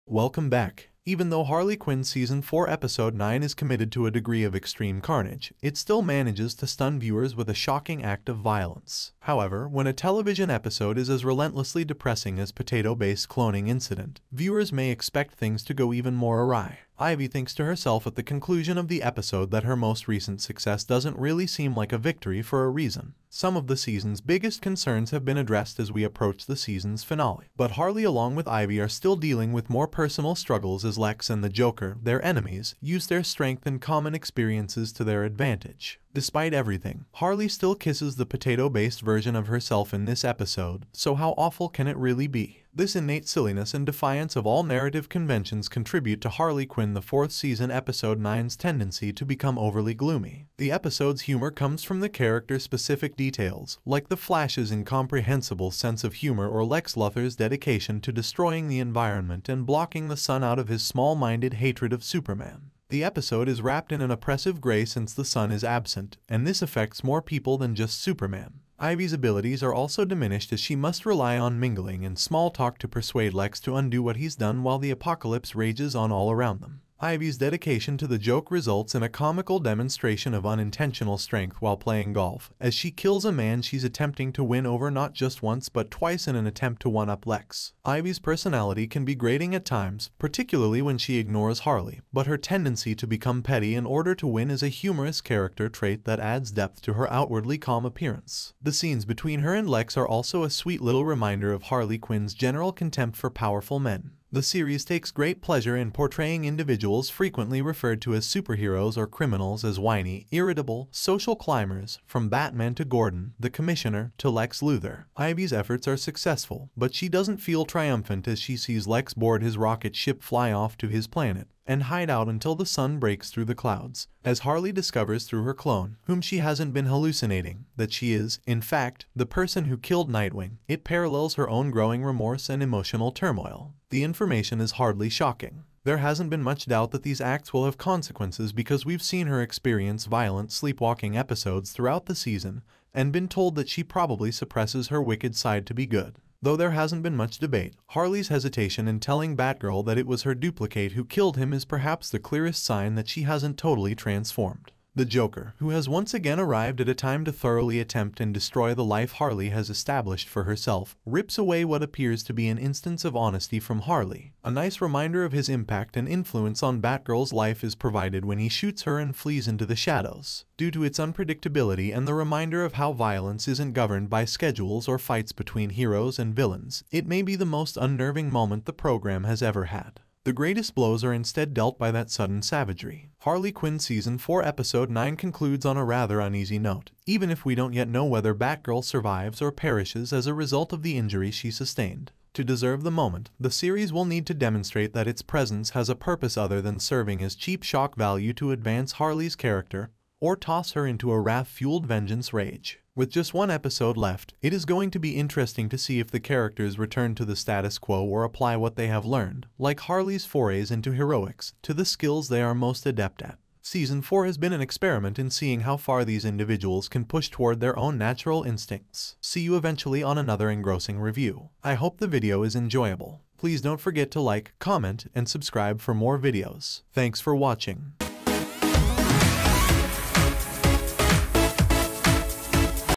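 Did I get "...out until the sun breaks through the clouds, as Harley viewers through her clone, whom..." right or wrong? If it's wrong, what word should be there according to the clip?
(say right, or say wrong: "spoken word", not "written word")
wrong: "discovers", not "viewers".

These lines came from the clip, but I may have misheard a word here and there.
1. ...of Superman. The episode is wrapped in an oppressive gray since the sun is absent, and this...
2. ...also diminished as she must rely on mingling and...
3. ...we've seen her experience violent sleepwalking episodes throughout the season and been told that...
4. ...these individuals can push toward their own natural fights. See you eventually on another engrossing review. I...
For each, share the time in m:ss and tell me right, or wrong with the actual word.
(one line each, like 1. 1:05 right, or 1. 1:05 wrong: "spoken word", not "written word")
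1. 1:01 right
2. 1:09 right
3. 2:18 right
4. 3:36 wrong: "instincts", not "fights".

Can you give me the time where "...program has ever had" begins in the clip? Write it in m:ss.
2:58.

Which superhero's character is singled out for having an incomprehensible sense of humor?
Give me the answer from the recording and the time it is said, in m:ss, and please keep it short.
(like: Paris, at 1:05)
The Flash, at 0:54.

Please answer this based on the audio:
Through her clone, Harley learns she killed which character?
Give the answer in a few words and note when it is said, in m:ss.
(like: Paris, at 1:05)
Nightwing, at 2:10.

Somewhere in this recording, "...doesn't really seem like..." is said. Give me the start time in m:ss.
0:20.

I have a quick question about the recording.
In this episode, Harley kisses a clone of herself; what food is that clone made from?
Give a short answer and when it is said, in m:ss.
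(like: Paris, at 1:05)
Potato, at 0:38.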